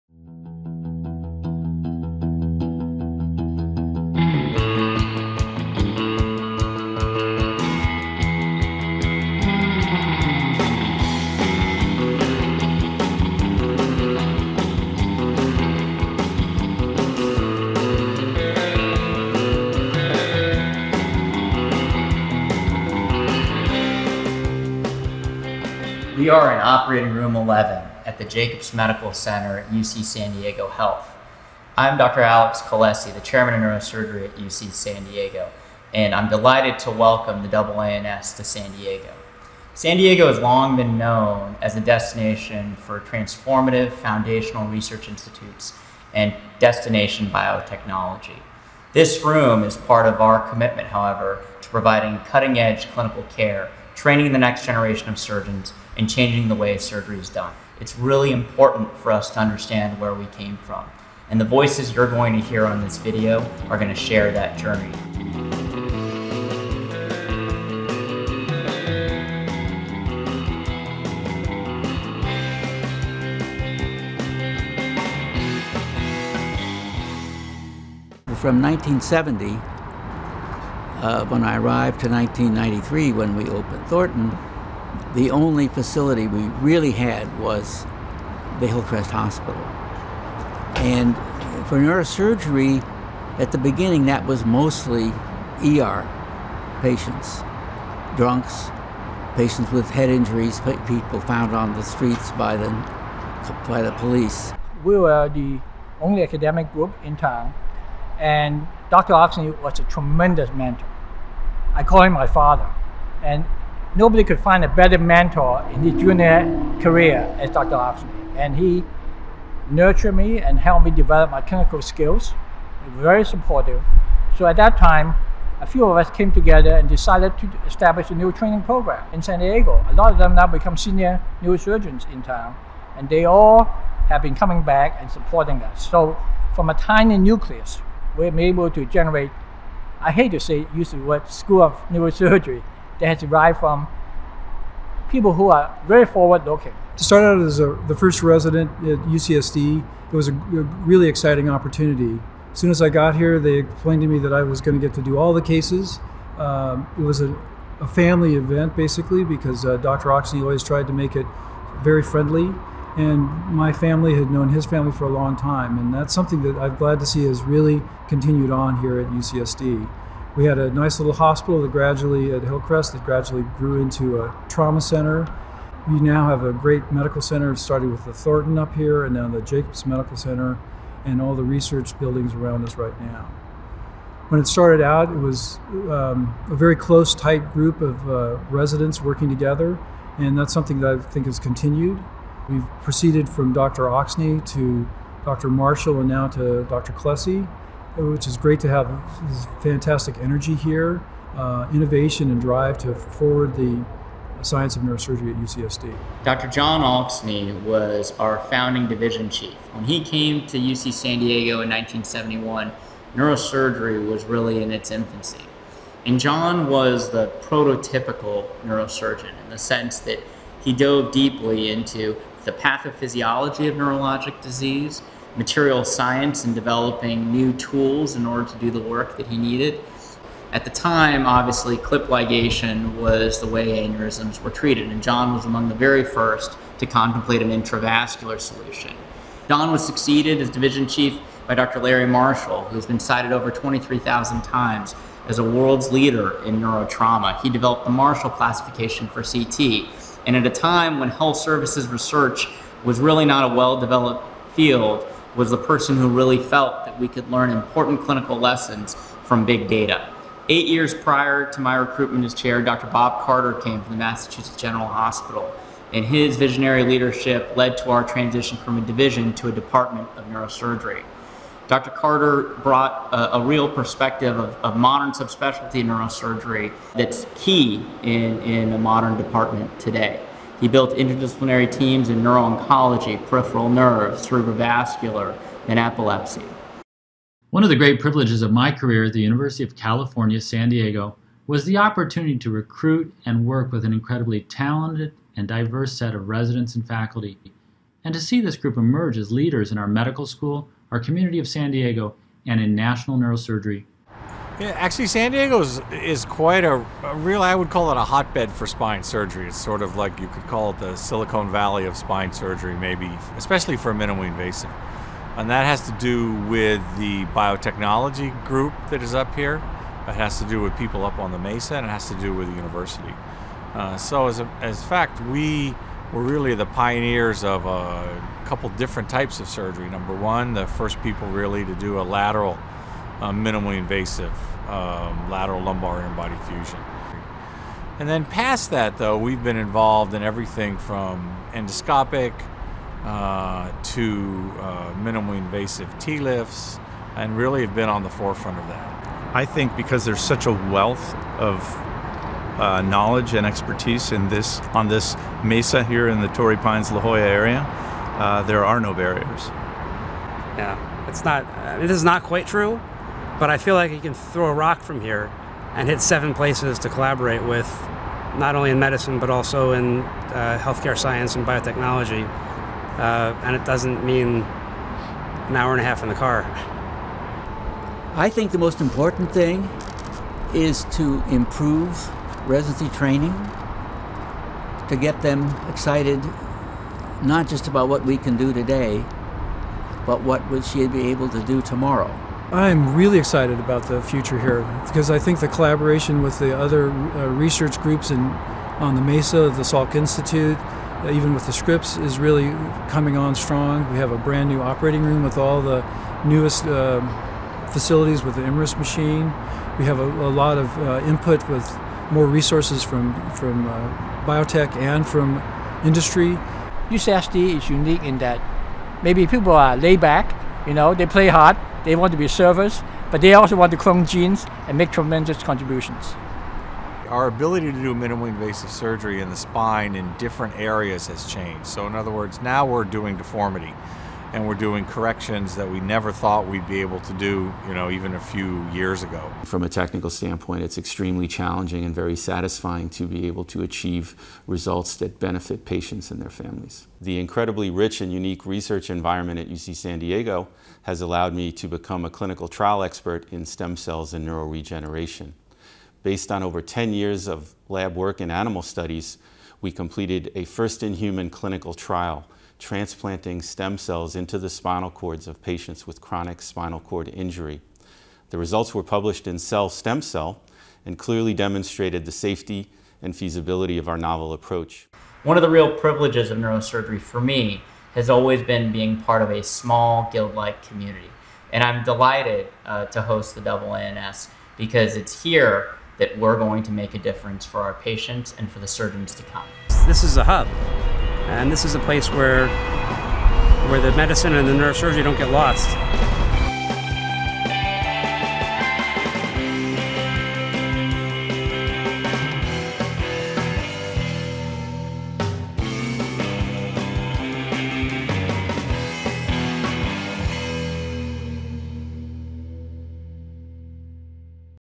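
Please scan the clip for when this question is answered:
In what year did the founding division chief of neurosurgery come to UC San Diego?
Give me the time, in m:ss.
3:31.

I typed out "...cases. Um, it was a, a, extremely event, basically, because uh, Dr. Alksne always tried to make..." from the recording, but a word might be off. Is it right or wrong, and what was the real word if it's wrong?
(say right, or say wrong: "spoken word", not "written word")
wrong: "family", not "extremely".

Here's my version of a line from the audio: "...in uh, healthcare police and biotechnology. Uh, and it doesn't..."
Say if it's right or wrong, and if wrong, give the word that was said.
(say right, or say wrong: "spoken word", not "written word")
wrong: "science", not "police".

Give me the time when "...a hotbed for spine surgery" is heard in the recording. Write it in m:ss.
5:07.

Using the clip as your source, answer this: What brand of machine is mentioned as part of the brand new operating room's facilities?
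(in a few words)
IMRIS.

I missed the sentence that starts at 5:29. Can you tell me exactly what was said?
Number one, the first people really to do a lateral, uh, minimally invasive um, lateral lumbar interbody fusion.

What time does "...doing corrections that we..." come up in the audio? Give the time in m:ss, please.
7:14.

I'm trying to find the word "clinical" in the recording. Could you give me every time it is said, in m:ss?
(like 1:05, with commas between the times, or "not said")
0:52, 2:01, 4:18, 7:32, 7:41.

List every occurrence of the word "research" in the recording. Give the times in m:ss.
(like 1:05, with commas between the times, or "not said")
0:44, 3:01, 4:11, 6:37, 7:28.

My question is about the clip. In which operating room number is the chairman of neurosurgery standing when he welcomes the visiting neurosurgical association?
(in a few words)
11.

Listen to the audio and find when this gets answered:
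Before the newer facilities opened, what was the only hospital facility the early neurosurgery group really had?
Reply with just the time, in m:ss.
1:28.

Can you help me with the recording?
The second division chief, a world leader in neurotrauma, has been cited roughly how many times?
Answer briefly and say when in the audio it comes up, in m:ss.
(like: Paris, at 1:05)
23,000, at 4:03.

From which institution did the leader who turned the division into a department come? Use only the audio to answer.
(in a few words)
Massachusetts General Hospital.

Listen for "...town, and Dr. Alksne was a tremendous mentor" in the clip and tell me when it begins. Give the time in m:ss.
1:47.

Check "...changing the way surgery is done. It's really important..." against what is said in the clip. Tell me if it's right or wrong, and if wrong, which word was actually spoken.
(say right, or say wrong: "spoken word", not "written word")
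right.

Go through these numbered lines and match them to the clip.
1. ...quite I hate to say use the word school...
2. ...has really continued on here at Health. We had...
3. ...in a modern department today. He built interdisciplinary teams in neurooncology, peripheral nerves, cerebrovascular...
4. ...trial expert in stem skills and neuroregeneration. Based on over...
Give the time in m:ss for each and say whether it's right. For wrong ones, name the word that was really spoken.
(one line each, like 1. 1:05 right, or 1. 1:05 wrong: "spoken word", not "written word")
1. 2:18 wrong: "generate", not "quite"
2. 2:47 wrong: "UCSD", not "Health"
3. 4:38 right
4. 7:32 wrong: "cells", not "skills".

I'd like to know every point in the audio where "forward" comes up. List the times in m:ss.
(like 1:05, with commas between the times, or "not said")
2:26, 3:22.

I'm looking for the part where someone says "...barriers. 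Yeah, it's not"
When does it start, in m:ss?
5:58.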